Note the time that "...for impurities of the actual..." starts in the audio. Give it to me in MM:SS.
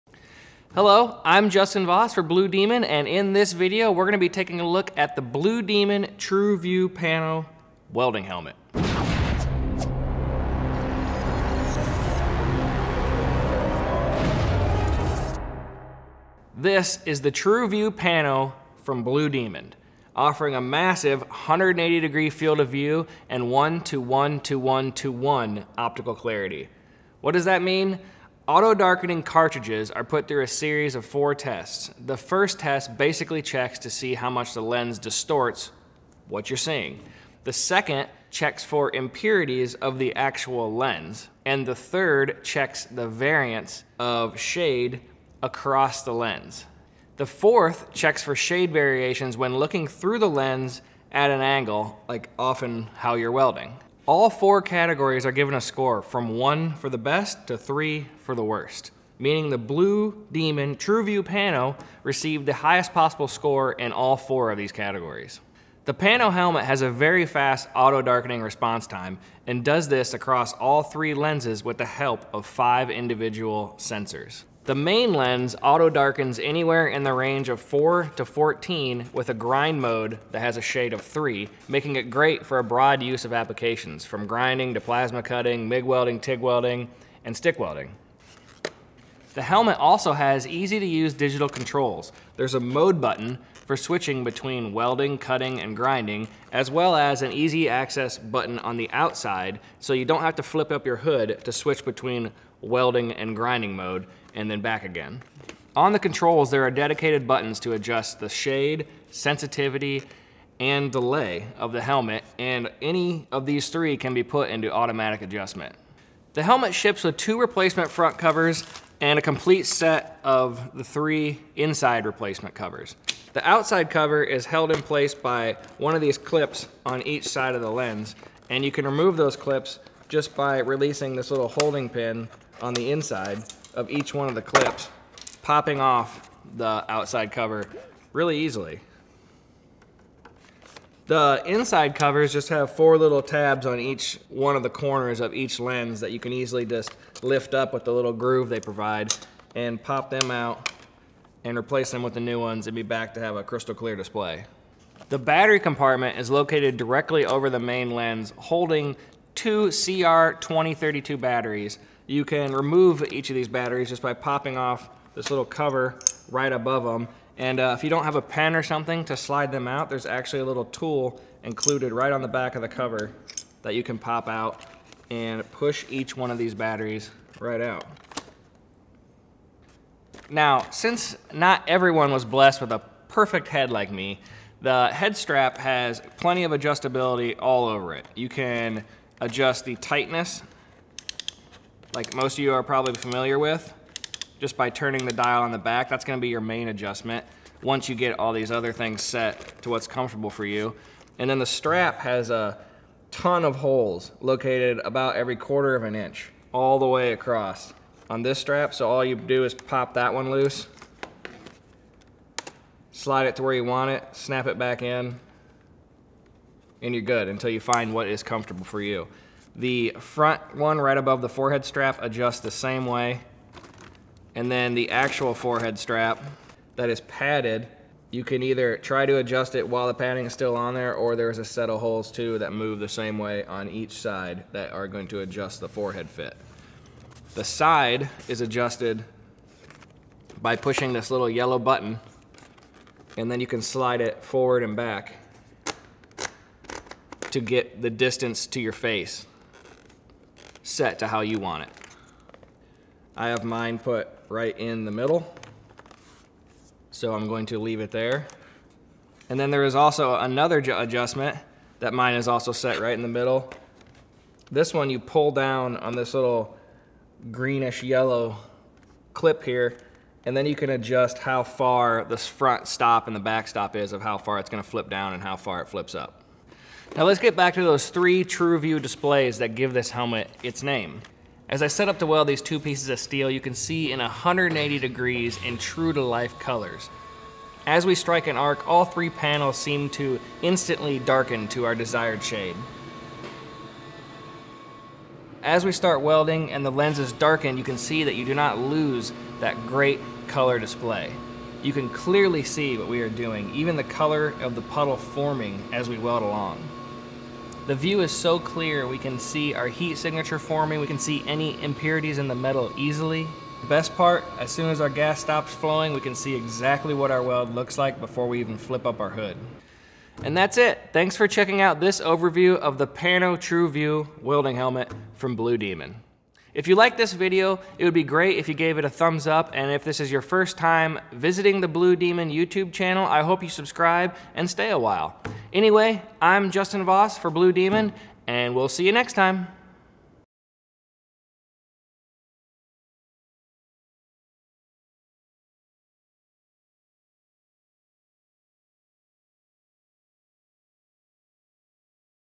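00:38.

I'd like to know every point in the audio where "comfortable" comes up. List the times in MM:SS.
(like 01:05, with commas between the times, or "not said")
03:19, 03:38.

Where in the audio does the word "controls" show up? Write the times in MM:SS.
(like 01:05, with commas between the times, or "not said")
01:31, 01:45.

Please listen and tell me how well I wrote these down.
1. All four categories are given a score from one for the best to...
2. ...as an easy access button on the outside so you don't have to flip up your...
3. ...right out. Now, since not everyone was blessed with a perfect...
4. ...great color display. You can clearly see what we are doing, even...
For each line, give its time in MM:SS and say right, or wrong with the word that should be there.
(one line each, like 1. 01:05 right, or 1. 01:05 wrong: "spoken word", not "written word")
1. 00:54 right
2. 01:36 right
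3. 02:57 right
4. 04:59 right.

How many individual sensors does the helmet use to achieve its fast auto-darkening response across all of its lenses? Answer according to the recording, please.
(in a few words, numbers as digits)
5.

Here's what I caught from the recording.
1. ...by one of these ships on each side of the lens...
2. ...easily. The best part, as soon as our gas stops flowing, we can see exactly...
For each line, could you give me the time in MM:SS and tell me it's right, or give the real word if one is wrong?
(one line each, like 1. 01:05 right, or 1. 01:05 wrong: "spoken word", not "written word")
1. 02:05 wrong: "clips", not "ships"
2. 05:12 right.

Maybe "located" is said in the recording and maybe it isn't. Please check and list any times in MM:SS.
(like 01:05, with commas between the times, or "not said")
02:36, 03:24.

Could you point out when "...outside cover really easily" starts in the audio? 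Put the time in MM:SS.
02:16.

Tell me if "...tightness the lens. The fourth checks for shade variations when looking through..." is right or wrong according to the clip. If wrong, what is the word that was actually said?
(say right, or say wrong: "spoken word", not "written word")
wrong: "across", not "tightness".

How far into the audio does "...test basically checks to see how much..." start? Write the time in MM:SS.
00:32.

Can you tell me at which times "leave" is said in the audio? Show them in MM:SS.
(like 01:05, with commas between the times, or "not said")
04:17.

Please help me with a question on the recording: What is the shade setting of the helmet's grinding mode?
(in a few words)
3.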